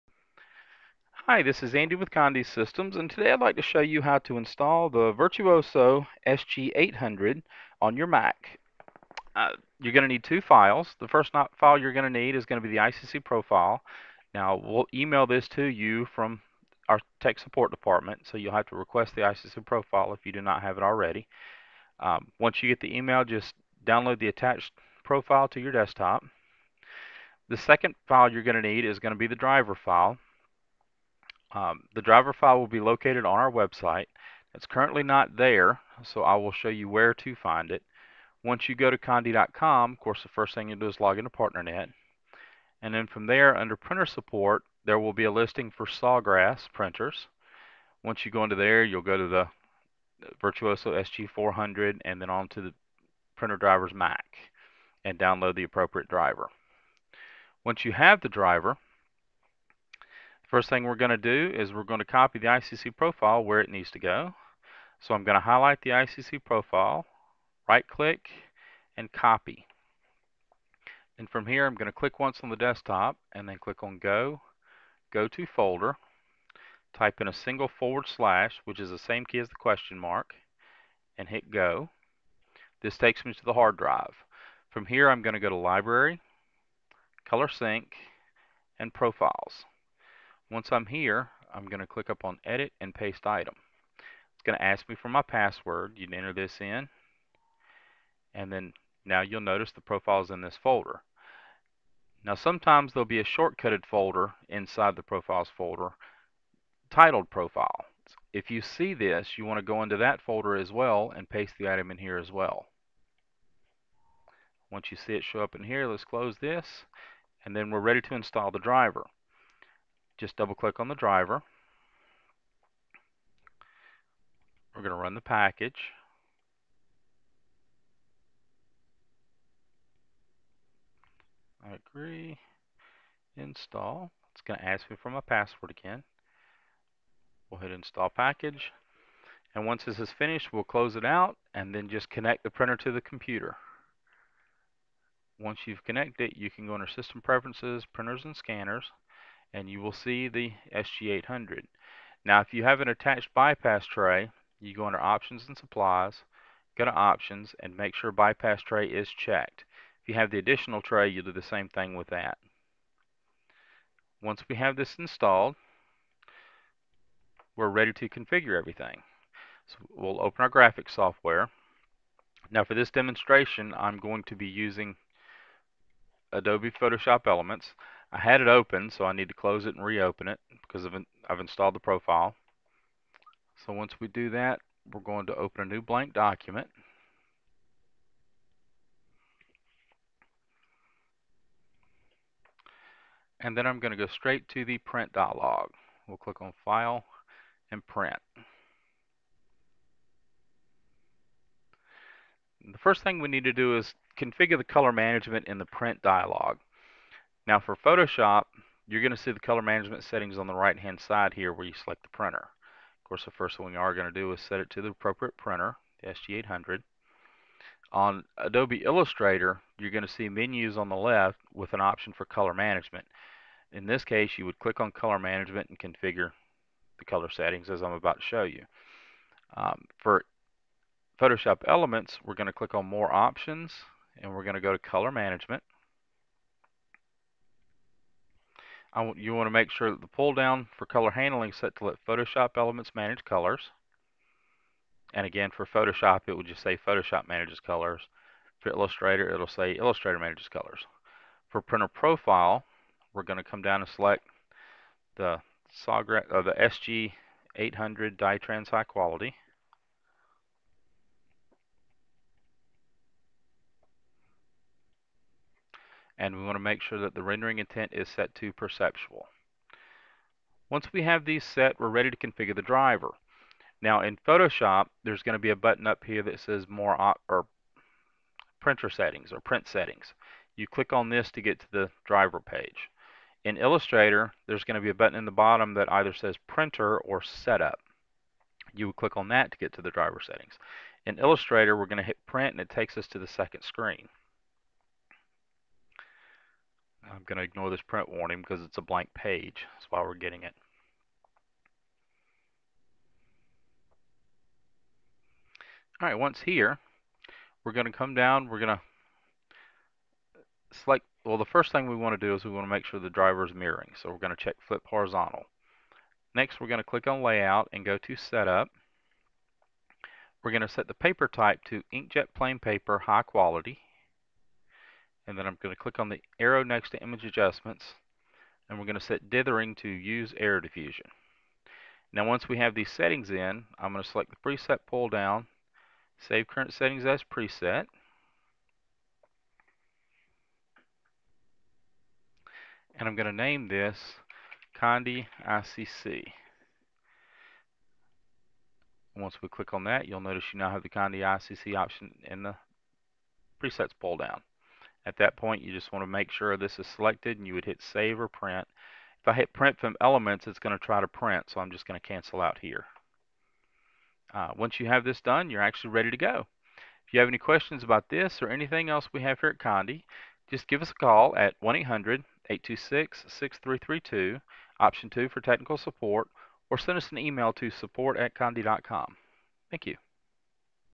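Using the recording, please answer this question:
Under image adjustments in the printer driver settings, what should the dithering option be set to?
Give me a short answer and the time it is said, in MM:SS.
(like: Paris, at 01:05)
Error diffusion, at 05:30.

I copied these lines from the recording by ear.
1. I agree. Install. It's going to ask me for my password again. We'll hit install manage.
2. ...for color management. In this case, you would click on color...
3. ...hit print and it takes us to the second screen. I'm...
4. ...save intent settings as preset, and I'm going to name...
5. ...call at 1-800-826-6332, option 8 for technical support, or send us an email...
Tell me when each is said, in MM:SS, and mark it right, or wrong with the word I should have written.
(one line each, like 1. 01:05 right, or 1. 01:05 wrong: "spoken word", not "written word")
1. 02:11 wrong: "package", not "manage"
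2. 03:42 right
3. 04:52 right
4. 05:36 wrong: "current", not "intent"
5. 06:10 wrong: "2", not "8".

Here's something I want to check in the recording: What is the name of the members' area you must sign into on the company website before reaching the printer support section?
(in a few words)
PartnerNet.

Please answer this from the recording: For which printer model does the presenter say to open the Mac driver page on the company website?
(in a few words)
Virtuoso SG400.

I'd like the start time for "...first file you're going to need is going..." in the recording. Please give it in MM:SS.
00:11.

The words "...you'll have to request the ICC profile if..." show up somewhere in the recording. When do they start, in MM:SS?
00:18.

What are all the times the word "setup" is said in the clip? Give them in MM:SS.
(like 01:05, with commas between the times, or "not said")
04:47, 05:18.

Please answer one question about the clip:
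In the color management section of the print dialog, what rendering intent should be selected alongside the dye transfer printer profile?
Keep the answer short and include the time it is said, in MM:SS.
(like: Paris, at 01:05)
Perceptual, at 04:28.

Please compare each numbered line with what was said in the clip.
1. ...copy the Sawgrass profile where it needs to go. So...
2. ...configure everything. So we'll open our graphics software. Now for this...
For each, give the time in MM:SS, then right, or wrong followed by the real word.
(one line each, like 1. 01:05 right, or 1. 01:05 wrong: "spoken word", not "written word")
1. 01:02 wrong: "ICC", not "Sawgrass"
2. 02:48 right.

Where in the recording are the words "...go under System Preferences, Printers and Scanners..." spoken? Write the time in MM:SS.
02:26.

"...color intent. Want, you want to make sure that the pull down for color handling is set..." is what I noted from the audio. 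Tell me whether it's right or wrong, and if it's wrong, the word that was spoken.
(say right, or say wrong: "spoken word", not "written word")
wrong: "management", not "intent".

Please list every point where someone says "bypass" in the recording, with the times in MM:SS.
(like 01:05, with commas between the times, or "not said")
02:33, 02:38.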